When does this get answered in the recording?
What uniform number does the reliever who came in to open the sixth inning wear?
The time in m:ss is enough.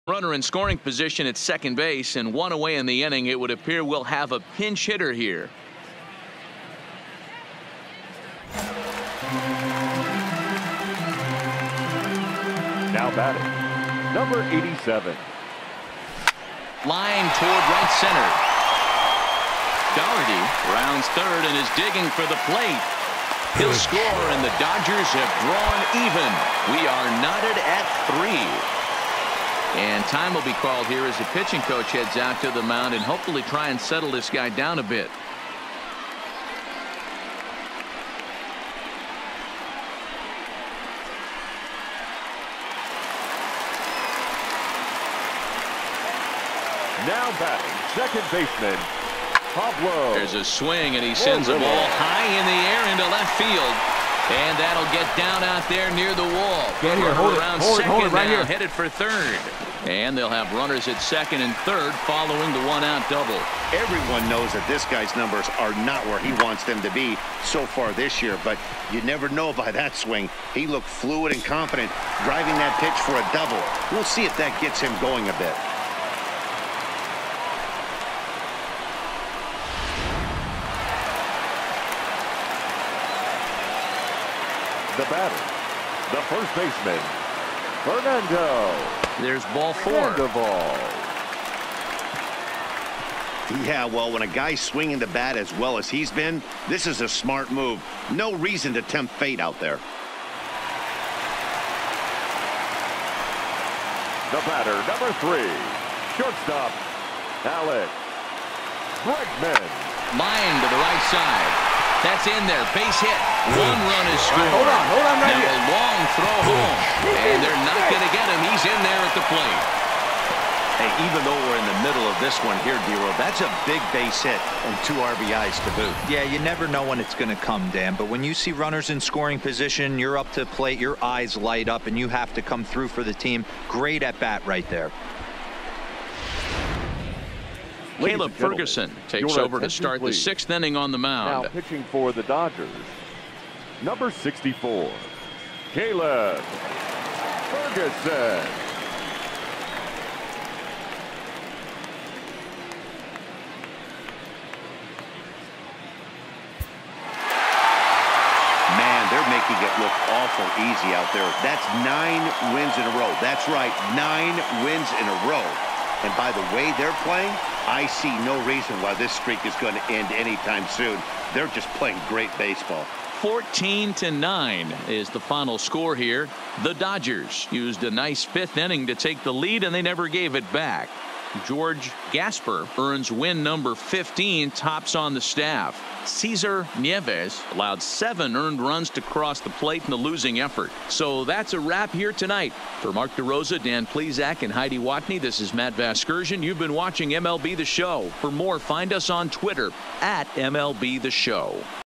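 2:24.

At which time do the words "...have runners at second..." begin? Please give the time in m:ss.
1:00.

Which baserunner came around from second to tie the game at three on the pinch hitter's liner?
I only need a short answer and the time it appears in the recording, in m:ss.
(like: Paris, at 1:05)
Doherty, at 0:19.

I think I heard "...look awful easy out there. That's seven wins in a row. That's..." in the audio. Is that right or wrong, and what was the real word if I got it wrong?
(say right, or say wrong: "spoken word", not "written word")
wrong: "nine", not "seven".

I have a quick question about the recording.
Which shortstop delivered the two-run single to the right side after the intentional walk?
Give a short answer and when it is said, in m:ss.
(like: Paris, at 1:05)
Alex Bregman, at 1:47.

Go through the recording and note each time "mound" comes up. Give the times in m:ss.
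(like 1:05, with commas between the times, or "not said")
0:32, 2:20.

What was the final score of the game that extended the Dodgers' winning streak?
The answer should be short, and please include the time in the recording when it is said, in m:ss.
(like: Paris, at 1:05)
14 to 9, at 2:53.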